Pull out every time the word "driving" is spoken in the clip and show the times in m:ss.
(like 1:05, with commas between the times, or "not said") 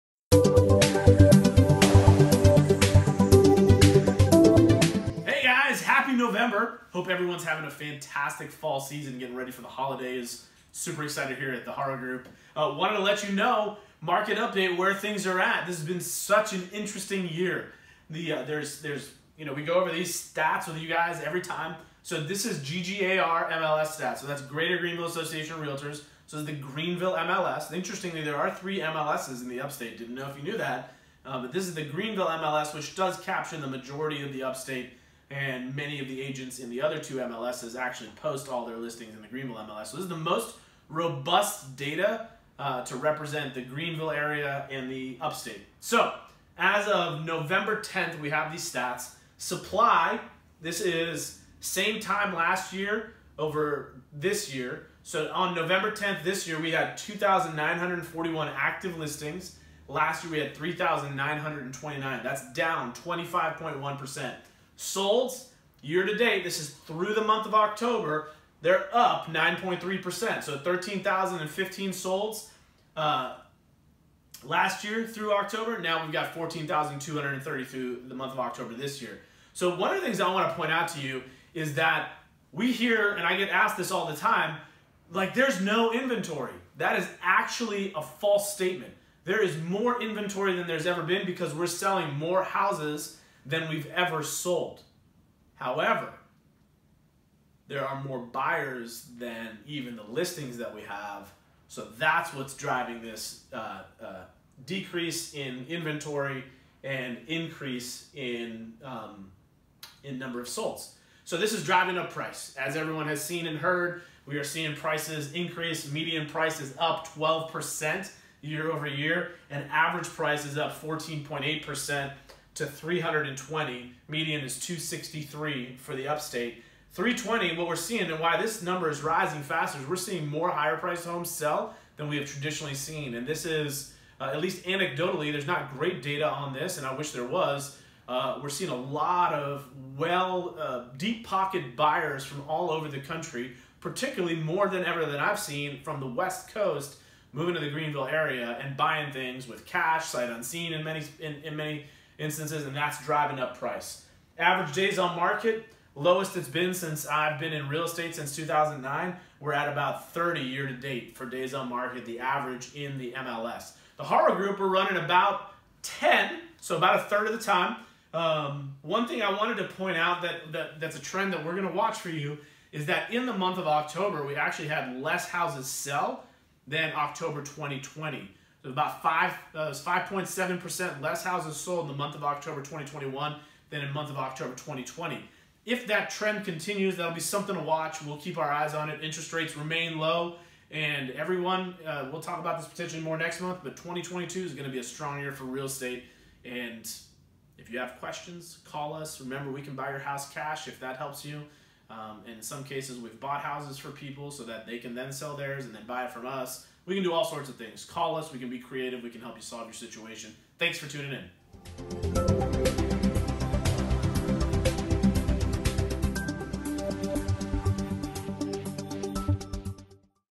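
1:42, 1:51, 2:33.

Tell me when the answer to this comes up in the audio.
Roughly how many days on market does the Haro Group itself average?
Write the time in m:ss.
2:45.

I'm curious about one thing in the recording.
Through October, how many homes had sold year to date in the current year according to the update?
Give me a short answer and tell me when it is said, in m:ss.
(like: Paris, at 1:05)
14,230, at 1:16.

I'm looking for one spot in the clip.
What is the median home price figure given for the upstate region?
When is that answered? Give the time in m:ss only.
2:04.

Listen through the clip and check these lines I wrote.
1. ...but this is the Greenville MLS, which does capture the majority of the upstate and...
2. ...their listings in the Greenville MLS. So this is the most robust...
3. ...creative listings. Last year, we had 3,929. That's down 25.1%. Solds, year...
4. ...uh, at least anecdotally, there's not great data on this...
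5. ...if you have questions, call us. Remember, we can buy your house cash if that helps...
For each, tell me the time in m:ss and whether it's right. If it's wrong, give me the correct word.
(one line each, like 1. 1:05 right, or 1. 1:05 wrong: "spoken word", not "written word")
1. 0:31 right
2. 0:38 right
3. 0:58 wrong: "active", not "creative"
4. 2:14 right
5. 3:17 right.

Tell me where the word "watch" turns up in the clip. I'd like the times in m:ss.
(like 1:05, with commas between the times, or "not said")
2:51, 3:07.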